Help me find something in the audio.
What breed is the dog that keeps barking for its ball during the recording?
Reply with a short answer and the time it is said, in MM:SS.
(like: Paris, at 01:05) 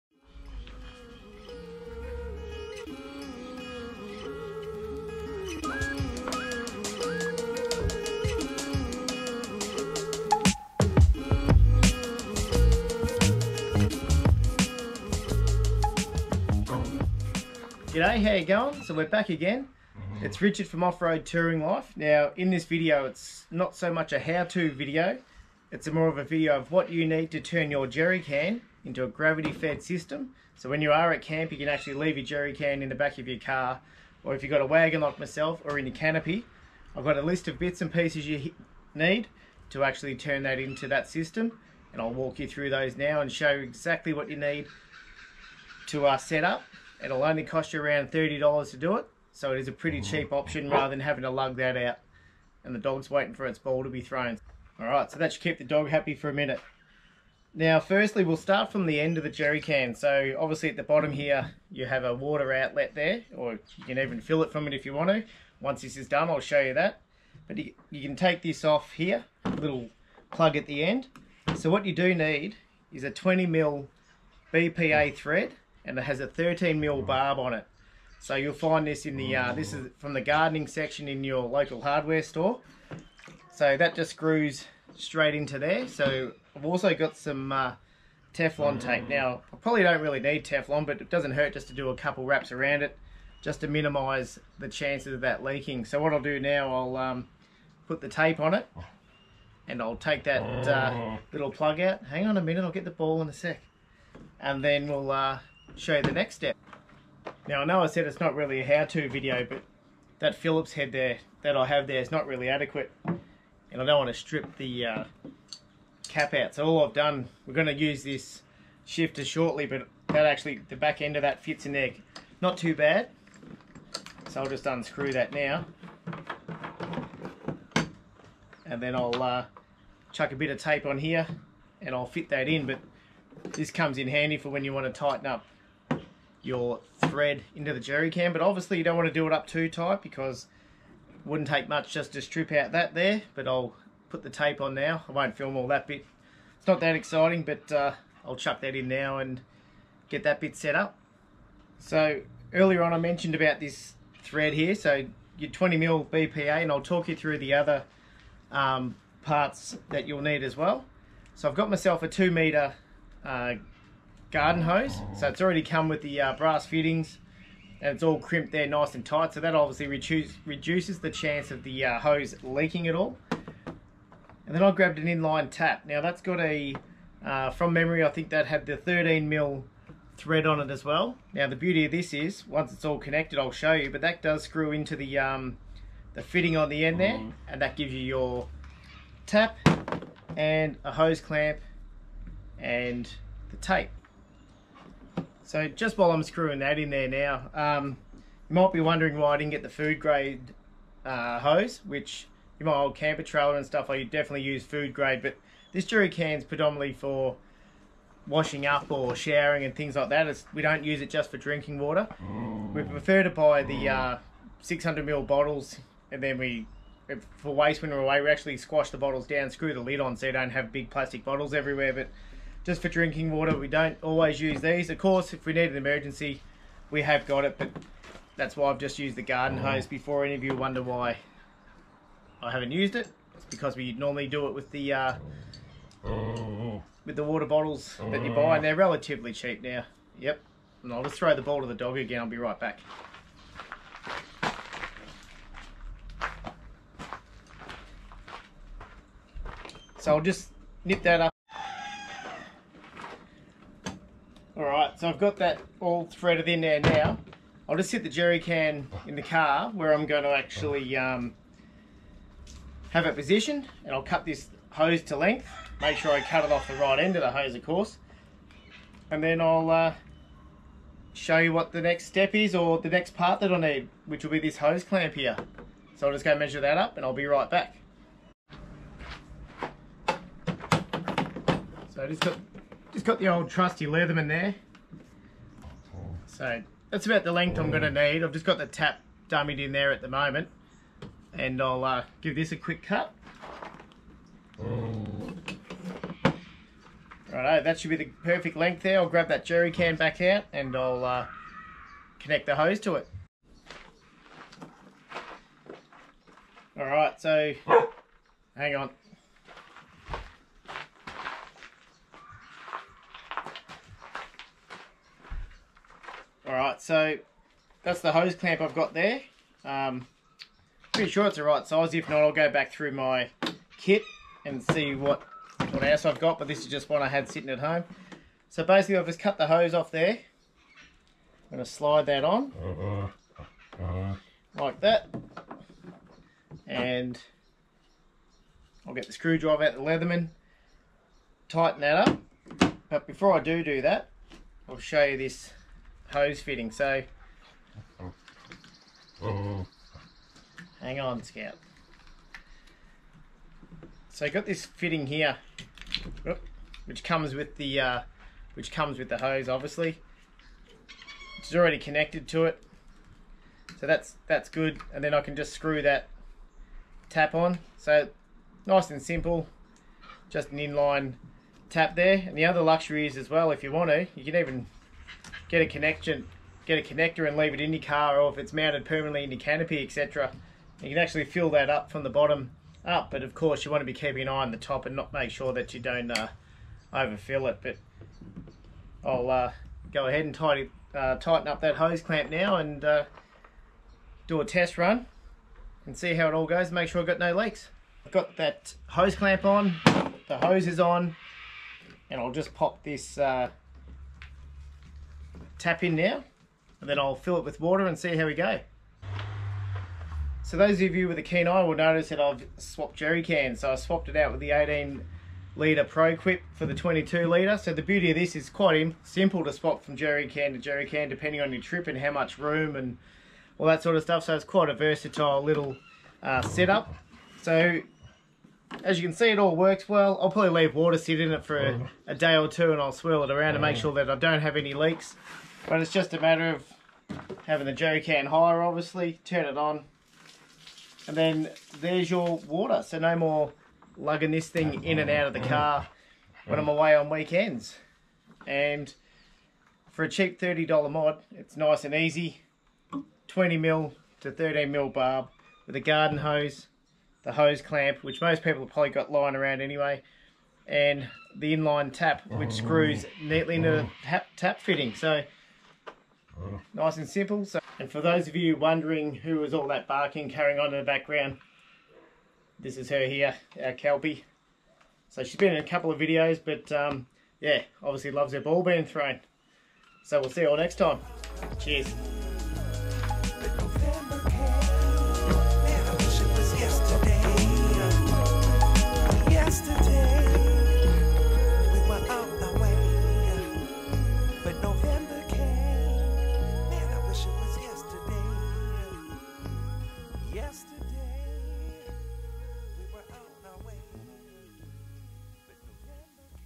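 Kelpie, at 07:53.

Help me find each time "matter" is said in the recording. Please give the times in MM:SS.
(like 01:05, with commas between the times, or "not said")
07:16.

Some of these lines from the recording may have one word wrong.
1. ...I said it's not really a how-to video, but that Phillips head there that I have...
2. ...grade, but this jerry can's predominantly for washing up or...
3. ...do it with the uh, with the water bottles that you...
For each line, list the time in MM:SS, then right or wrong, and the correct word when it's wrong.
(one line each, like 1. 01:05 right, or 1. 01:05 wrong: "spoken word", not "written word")
1. 01:47 right
2. 03:24 right
3. 03:54 right.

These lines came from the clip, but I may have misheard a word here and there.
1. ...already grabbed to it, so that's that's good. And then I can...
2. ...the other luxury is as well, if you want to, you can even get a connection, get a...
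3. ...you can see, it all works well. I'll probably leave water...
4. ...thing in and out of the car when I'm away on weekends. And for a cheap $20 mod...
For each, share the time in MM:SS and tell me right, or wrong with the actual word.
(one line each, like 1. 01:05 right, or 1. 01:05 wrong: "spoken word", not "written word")
1. 06:01 wrong: "connected", not "grabbed"
2. 06:12 right
3. 07:08 right
4. 07:24 wrong: "30", not "20".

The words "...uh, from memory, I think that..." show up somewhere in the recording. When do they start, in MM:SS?
02:57.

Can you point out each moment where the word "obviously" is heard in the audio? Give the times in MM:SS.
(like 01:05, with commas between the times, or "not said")
01:00, 02:18, 02:49, 05:59, 07:18, 07:57.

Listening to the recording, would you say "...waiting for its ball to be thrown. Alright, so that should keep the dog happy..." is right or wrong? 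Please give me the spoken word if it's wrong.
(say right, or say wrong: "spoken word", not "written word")
right.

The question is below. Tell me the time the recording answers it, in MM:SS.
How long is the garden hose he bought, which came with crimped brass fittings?
02:42.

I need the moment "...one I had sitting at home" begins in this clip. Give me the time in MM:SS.
05:26.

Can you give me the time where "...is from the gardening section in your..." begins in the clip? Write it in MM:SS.
01:19.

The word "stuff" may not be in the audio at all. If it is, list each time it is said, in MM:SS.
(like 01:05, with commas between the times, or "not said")
03:23, 07:04.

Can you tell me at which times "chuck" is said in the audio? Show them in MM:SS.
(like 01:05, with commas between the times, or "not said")
02:10, 02:28.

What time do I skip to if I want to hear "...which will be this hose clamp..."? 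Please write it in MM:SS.
04:34.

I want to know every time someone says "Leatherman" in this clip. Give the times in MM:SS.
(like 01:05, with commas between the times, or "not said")
04:43, 05:39.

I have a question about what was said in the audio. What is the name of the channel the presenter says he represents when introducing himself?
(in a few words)
Off-Road Touring Life.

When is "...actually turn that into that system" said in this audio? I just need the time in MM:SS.
00:39.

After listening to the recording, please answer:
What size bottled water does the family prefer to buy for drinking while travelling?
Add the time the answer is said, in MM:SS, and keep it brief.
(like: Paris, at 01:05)
600 ml, at 03:34.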